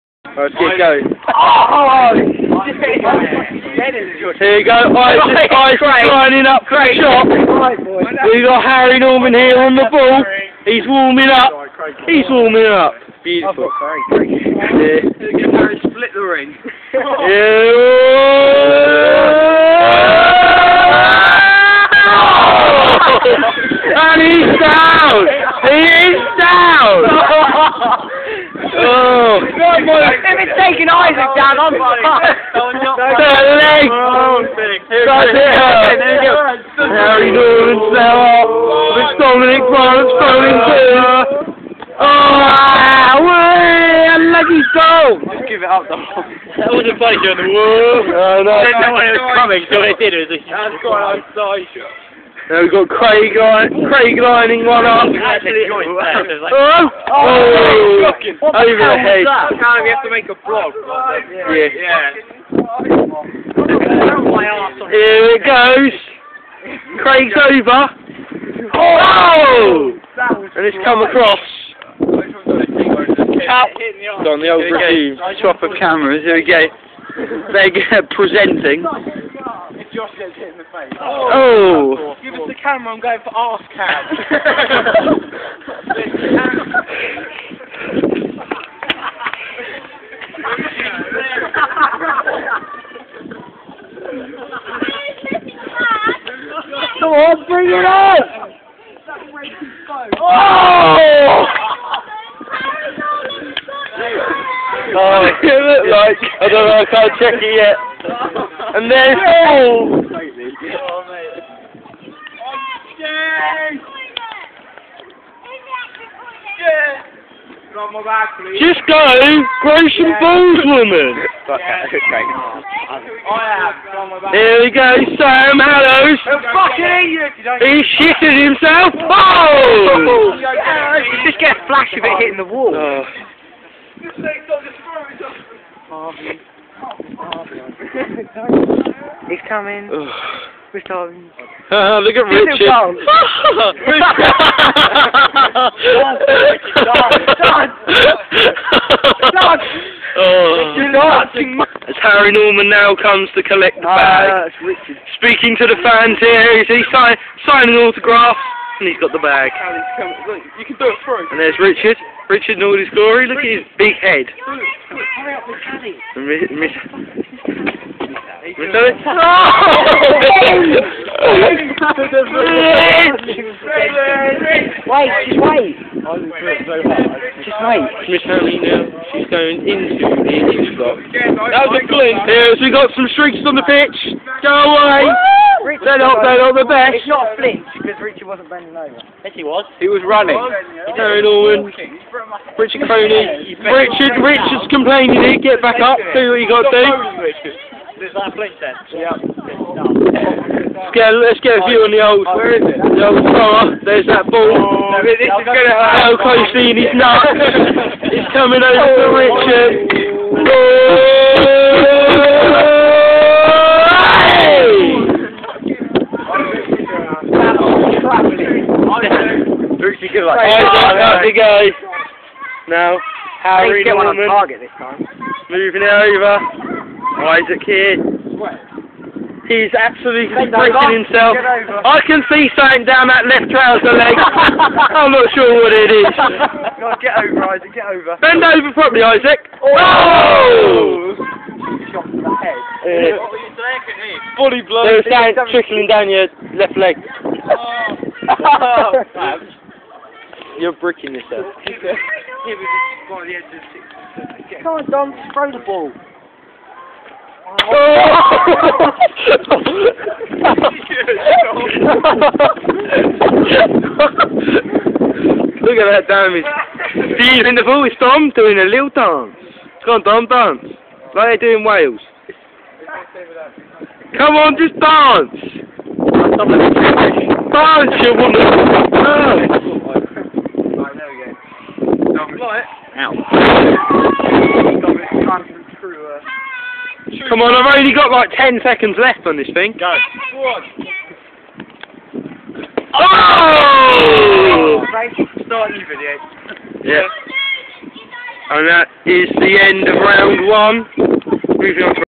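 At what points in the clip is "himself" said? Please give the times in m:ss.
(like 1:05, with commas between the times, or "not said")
2:08, 3:51.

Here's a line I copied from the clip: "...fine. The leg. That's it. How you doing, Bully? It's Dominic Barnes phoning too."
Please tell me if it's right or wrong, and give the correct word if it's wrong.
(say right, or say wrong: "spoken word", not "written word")
wrong: "Sarah", not "Bully".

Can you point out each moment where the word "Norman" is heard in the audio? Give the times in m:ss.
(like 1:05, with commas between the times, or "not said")
0:08, 2:32, 3:11, 3:43.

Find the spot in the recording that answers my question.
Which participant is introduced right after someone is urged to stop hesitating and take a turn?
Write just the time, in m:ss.
2:05.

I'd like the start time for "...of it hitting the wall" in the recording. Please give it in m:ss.
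2:11.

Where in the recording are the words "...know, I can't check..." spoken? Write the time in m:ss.
1:46.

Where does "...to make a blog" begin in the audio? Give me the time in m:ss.
1:00.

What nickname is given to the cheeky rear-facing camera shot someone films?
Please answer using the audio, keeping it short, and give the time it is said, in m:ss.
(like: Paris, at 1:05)
arse cam, at 1:23.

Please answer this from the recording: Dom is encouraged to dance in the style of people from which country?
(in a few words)
Wales.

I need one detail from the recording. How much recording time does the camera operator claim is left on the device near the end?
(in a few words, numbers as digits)
10 seconds.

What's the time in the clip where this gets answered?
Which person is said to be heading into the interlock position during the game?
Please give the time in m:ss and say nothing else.
2:58.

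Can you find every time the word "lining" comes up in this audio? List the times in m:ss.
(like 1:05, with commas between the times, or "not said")
0:05, 0:54.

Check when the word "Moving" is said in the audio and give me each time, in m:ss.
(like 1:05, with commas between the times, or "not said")
3:45, 5:01.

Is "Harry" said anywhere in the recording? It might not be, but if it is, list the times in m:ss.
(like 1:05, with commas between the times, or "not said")
0:08, 0:13, 2:32, 3:43.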